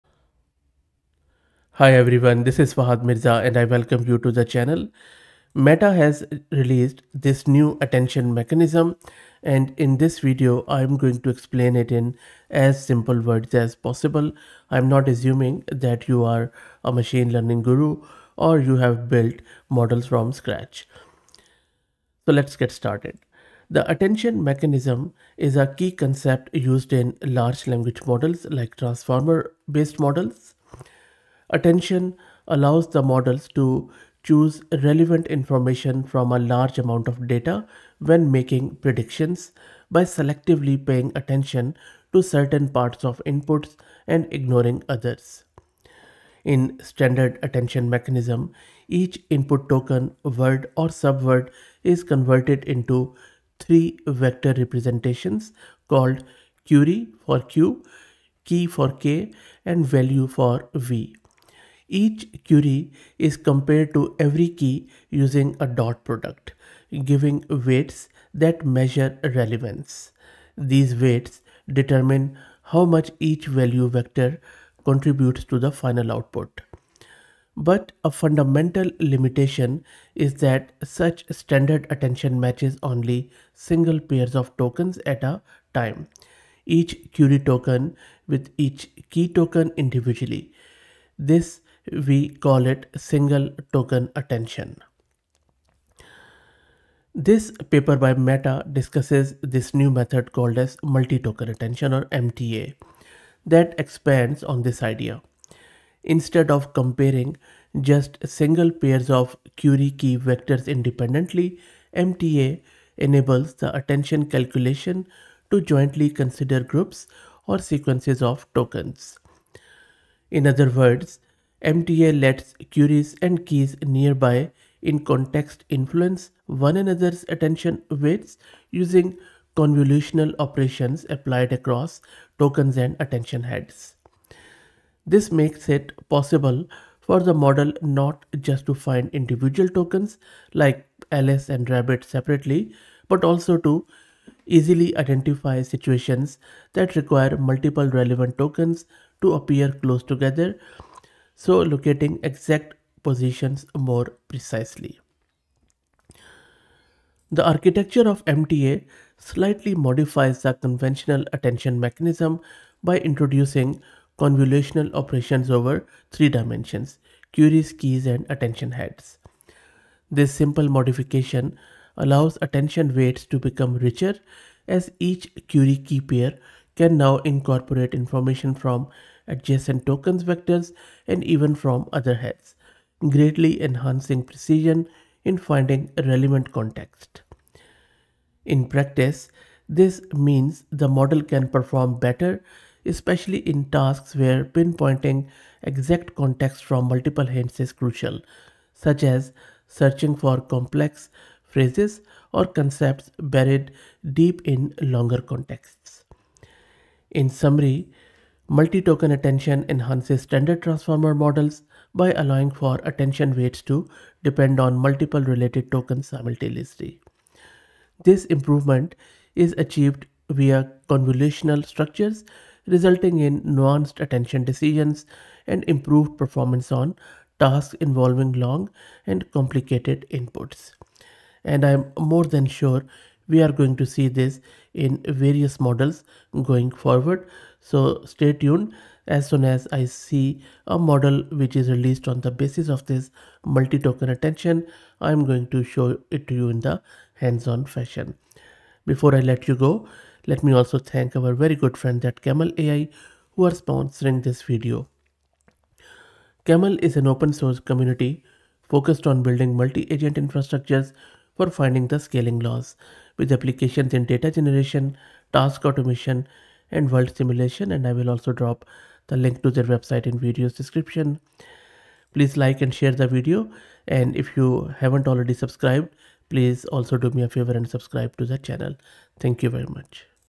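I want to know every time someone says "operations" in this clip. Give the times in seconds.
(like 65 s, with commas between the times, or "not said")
130 s, 164 s.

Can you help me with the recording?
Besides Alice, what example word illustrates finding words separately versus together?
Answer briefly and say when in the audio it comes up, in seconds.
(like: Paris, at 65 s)
Rabbit, at 141 s.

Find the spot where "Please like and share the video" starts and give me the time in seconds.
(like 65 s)
272 s.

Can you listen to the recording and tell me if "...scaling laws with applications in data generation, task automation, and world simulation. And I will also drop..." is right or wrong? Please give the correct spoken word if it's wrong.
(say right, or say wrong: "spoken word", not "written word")
right.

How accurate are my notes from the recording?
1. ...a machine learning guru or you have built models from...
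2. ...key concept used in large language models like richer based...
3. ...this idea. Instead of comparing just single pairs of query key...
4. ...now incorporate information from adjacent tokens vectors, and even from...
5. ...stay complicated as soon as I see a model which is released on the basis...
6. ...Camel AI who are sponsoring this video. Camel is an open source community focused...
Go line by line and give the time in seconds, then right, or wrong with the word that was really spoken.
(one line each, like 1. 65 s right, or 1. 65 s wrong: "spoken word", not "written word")
1. 16 s right
2. 25 s wrong: "transformer", not "richer"
3. 104 s right
4. 176 s right
5. 238 s wrong: "tuned", not "complicated"
6. 252 s right.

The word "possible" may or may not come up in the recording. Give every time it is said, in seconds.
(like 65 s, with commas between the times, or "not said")
13 s, 136 s.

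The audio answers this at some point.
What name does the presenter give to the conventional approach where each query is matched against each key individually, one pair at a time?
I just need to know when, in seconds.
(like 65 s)
92 s.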